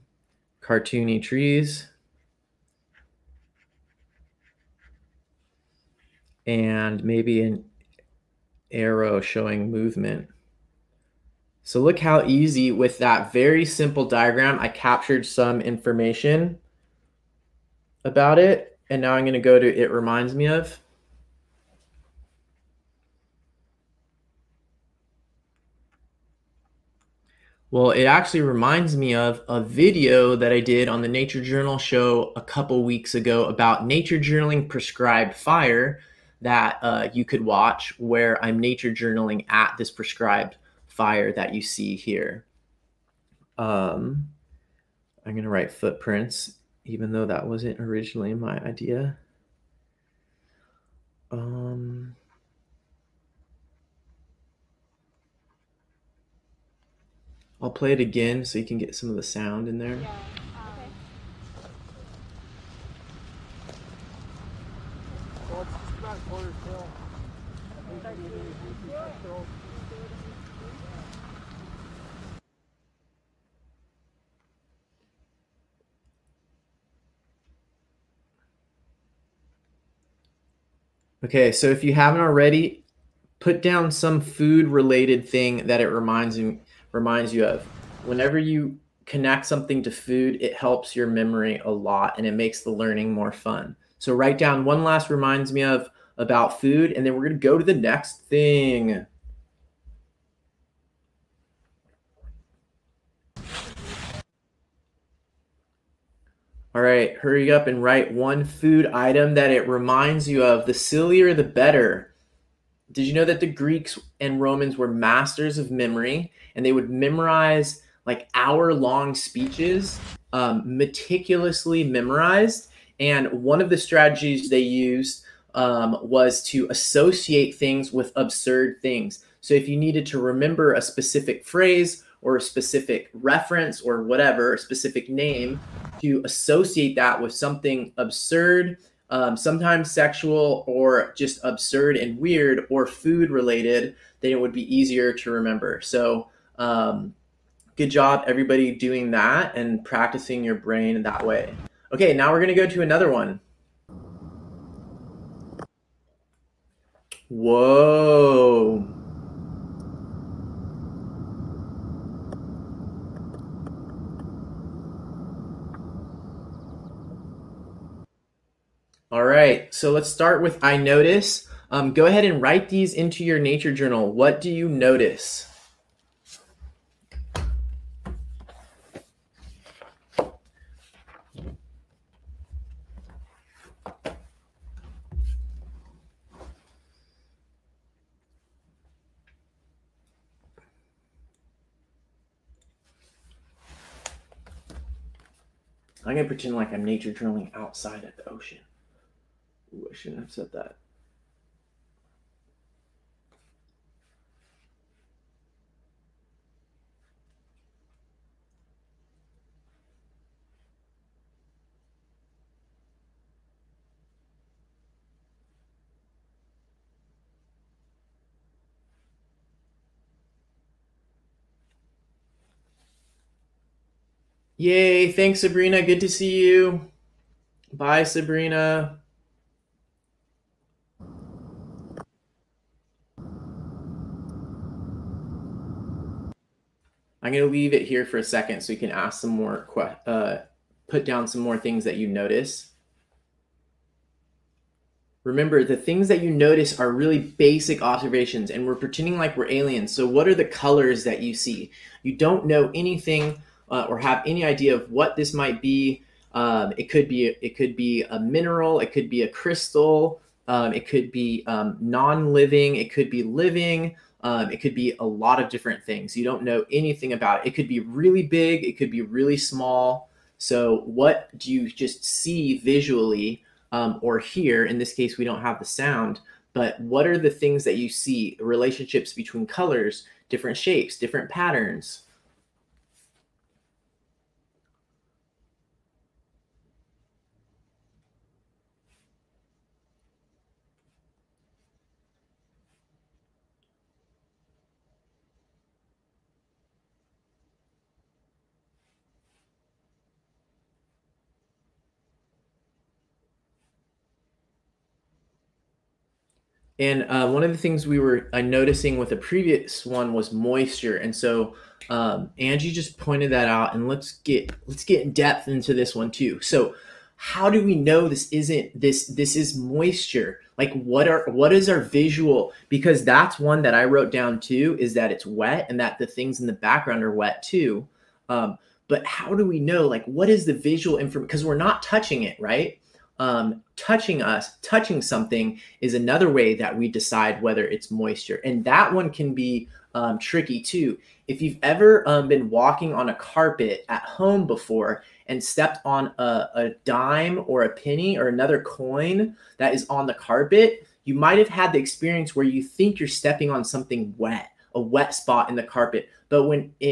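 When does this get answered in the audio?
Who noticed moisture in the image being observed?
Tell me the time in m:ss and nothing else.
5:12.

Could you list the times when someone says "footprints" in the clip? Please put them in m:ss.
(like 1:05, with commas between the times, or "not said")
0:45.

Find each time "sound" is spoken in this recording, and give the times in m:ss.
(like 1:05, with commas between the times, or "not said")
0:59, 4:35.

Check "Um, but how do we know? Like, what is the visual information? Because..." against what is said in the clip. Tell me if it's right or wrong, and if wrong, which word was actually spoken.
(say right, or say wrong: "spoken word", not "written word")
right.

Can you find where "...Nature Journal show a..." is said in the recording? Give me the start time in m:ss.
0:31.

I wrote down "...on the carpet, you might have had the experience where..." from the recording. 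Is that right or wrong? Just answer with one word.
right.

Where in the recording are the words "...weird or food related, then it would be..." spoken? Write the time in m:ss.
2:22.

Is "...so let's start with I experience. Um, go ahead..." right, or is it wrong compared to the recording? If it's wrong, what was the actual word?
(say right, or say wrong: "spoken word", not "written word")
wrong: "notice", not "experience".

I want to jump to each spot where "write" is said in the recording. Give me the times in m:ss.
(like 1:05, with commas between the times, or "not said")
0:45, 1:34, 1:47, 2:52.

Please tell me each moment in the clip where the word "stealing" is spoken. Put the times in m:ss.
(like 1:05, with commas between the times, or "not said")
not said.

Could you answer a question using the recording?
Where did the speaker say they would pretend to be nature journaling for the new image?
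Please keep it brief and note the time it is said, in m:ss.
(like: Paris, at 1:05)
The ocean, at 3:18.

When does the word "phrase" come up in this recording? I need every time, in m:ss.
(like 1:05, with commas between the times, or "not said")
2:11.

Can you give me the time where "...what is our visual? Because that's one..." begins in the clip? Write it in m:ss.
5:21.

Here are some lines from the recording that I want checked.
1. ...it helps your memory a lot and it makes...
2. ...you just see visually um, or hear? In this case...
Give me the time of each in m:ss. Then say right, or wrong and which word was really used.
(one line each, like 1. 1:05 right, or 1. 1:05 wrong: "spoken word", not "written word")
1. 1:30 right
2. 4:31 right.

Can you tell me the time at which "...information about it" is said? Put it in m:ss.
0:15.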